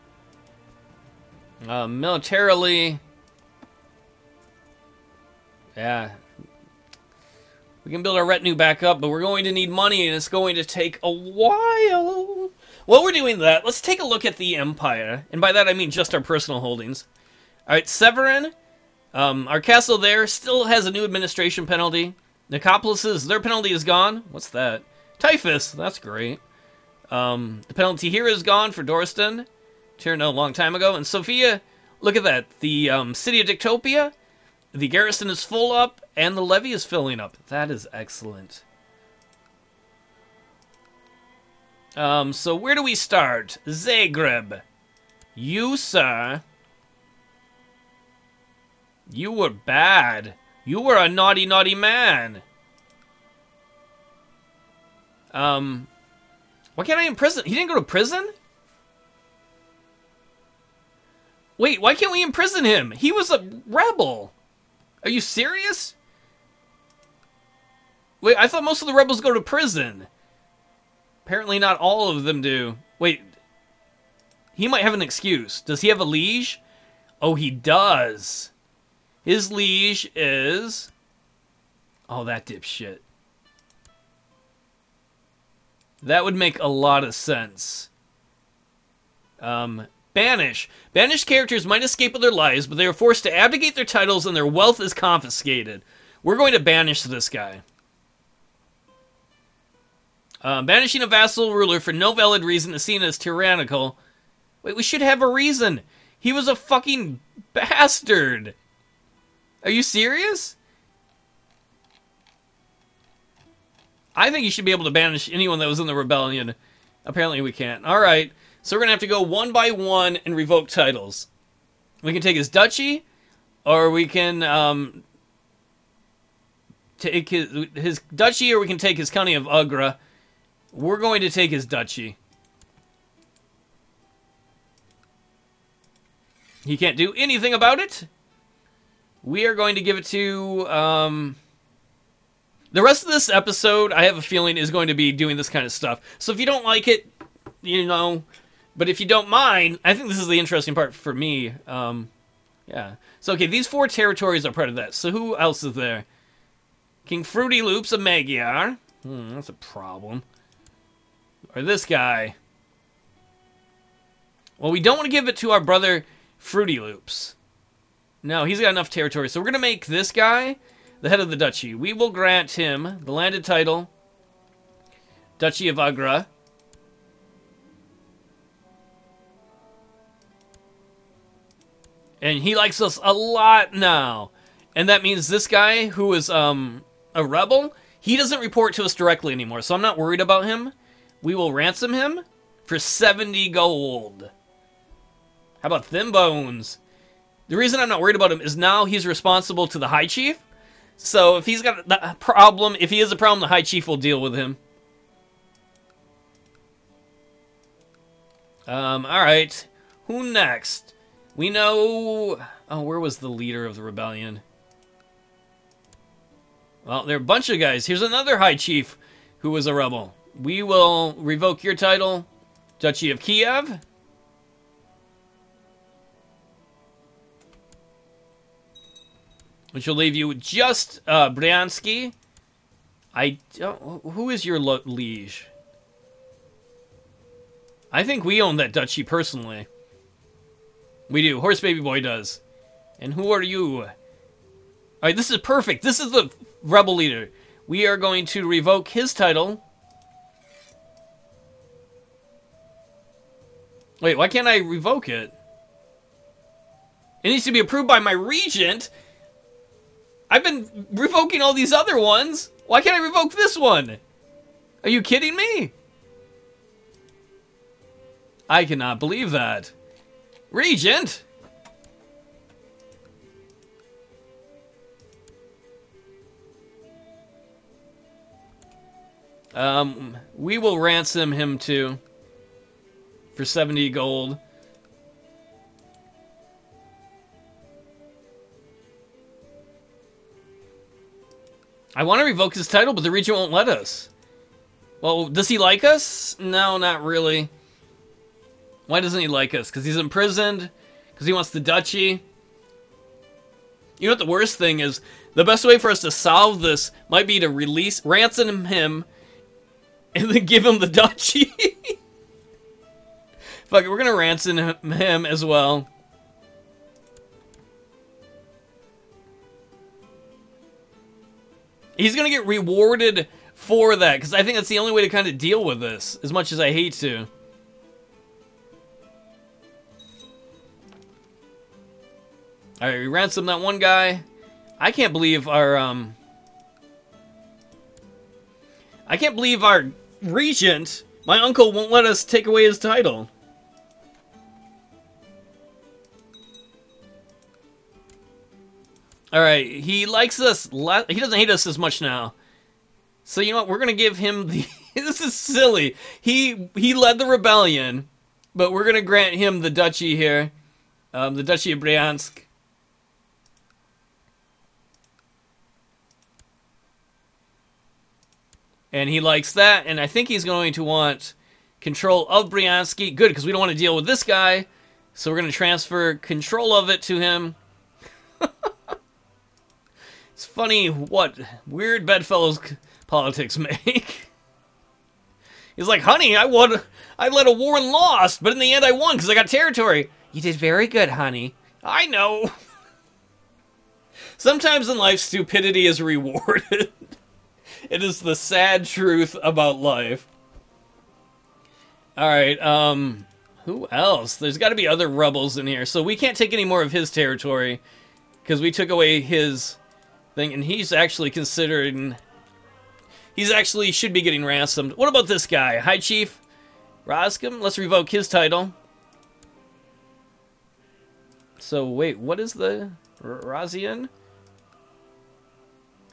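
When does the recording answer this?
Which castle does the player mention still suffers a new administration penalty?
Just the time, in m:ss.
0:17.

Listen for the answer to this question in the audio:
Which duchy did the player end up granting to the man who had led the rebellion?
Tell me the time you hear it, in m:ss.
6:01.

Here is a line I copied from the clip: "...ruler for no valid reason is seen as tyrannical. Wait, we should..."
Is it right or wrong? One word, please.
right.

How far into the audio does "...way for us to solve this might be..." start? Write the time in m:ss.
5:05.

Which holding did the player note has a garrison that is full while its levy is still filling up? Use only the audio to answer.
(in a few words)
Dictopia.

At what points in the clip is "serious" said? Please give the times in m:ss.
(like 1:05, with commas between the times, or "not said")
1:05, 1:49.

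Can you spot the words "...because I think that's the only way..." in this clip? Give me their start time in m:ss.
5:24.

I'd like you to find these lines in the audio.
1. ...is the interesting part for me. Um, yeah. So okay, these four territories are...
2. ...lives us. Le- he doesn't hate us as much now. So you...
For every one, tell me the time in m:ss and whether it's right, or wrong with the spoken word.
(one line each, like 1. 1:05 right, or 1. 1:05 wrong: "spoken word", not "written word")
1. 2:30 right
2. 5:50 wrong: "likes", not "lives".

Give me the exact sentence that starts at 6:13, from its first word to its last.
Good, because we don't want to deal with this guy, so we're going to transfer control of it to him.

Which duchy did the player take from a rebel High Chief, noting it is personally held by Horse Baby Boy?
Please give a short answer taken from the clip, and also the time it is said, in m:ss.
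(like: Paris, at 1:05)
Duchy of Kiev, at 3:42.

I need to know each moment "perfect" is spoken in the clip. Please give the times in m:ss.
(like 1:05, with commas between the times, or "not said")
4:05.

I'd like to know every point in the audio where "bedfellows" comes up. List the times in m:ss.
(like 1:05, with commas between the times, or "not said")
6:22.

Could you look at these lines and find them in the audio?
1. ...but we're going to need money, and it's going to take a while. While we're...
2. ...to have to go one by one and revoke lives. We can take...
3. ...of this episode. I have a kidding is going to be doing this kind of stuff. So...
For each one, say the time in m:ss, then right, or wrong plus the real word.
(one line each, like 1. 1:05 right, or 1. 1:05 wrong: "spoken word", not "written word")
1. 0:09 right
2. 1:58 wrong: "titles", not "lives"
3. 2:23 wrong: "feeling", not "kidding".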